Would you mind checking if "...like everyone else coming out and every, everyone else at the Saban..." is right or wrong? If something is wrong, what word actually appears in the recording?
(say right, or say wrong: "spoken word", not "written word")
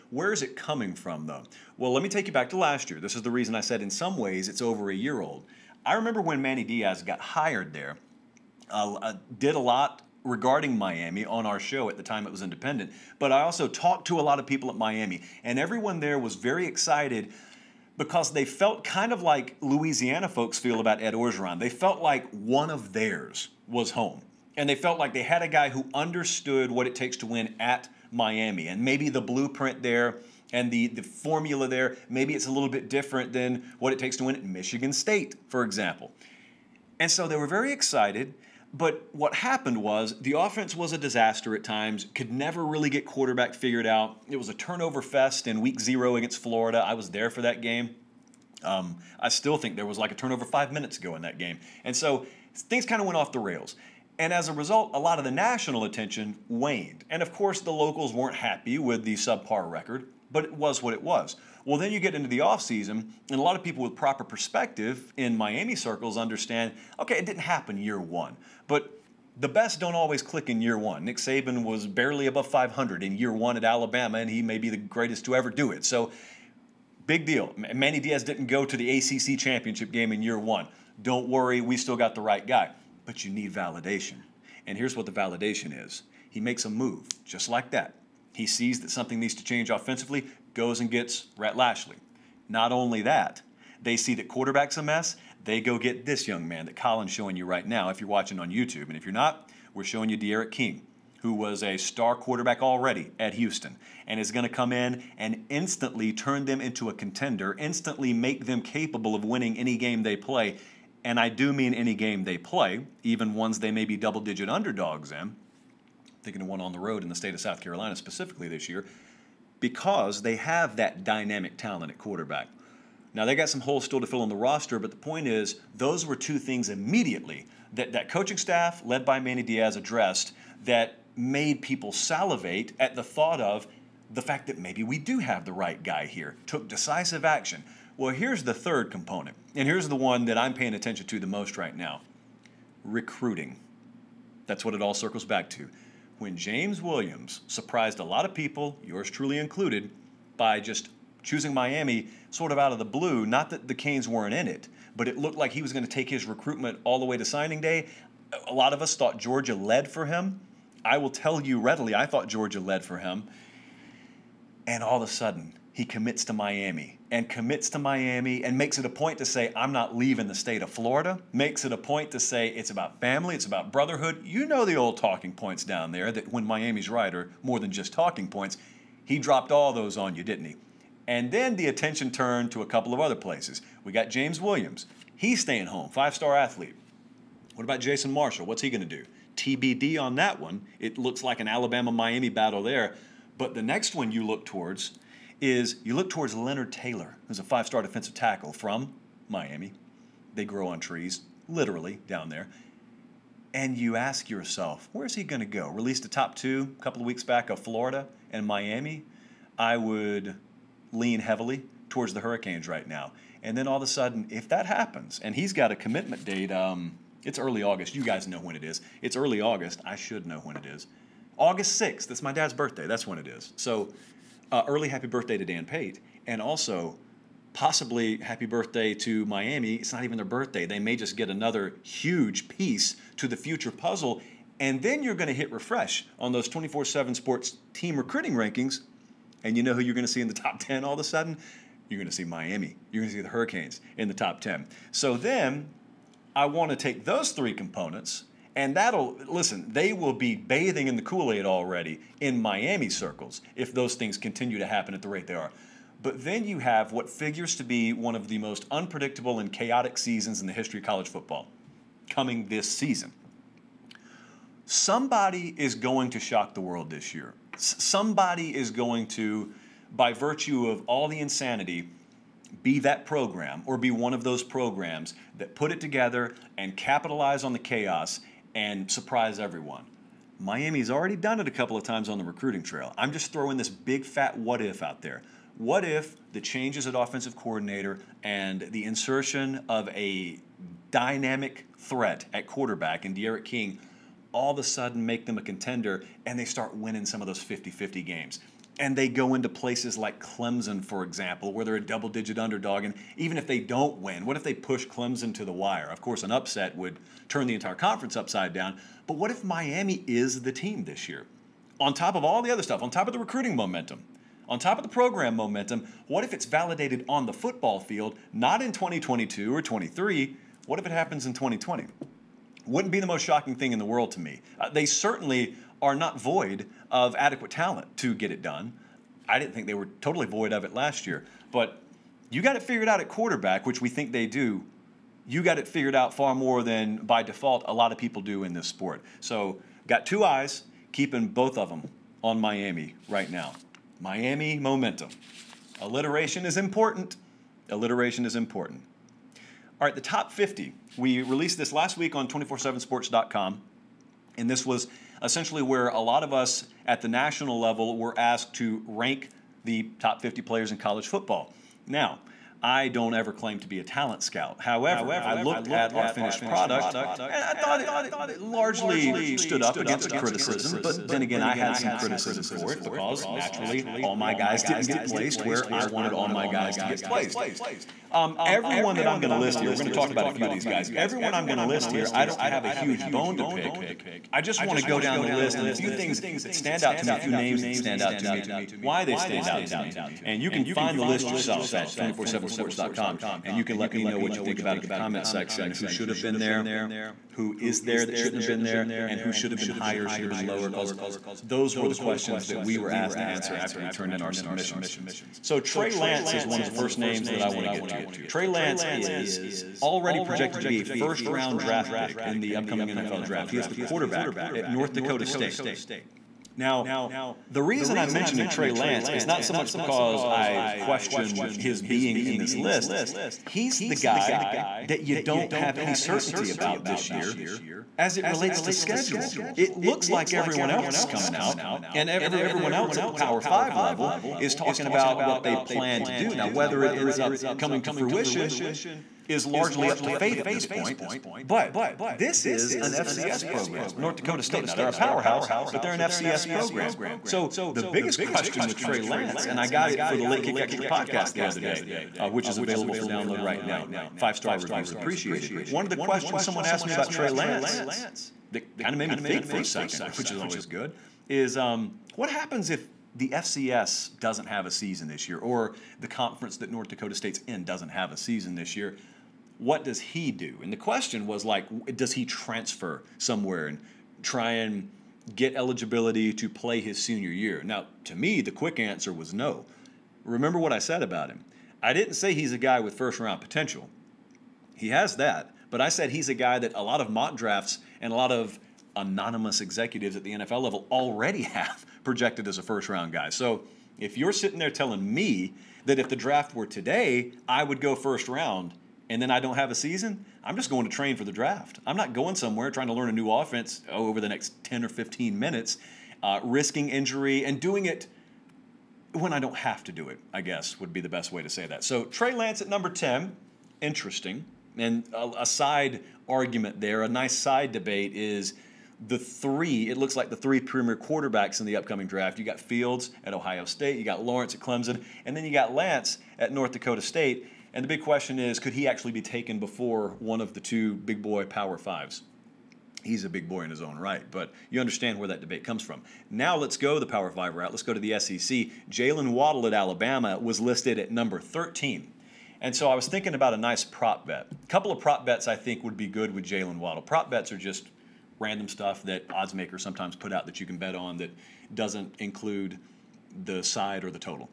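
wrong: "Power", not "Saban".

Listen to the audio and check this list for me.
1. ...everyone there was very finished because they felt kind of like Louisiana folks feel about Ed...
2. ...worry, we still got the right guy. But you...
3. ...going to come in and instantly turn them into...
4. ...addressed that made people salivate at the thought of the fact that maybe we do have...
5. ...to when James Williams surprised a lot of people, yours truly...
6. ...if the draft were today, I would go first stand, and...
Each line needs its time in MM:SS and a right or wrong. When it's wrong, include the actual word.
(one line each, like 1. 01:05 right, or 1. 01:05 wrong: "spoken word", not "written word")
1. 00:15 wrong: "excited", not "finished"
2. 01:21 right
3. 01:44 right
4. 02:09 right
5. 02:25 right
6. 08:15 wrong: "round", not "stand".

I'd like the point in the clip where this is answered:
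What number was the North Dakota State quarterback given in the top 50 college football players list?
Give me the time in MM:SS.
08:32.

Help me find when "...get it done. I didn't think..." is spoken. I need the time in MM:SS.
05:28.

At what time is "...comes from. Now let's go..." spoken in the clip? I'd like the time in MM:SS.
08:55.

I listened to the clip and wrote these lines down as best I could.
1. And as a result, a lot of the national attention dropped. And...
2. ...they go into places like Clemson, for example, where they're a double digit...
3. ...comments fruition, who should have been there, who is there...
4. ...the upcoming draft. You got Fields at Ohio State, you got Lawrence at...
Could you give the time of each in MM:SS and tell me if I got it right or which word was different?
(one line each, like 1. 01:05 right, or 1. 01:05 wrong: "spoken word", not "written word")
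1. 00:54 wrong: "waned", not "dropped"
2. 04:58 right
3. 06:34 wrong: "section", not "fruition"
4. 08:41 right.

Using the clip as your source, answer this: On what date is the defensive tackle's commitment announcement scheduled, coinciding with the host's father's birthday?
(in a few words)
August 6.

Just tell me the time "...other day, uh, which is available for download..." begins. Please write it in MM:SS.
07:31.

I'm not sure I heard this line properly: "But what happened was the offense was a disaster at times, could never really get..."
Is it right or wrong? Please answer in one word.
right.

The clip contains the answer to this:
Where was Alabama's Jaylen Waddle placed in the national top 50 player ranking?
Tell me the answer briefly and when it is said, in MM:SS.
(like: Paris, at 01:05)
13, at 09:01.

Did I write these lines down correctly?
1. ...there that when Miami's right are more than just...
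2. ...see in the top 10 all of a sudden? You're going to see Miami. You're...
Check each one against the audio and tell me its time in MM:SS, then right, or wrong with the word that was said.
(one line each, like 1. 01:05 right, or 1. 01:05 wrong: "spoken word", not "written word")
1. 02:55 right
2. 04:00 right.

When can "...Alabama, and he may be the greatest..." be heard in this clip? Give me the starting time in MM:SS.
01:13.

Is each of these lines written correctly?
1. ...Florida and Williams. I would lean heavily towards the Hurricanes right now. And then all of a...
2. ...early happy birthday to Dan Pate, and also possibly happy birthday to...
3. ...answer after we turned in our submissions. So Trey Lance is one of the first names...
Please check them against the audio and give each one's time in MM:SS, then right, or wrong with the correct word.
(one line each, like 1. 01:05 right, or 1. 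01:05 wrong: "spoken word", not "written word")
1. 03:27 wrong: "Miami", not "Williams"
2. 03:44 right
3. 06:43 right.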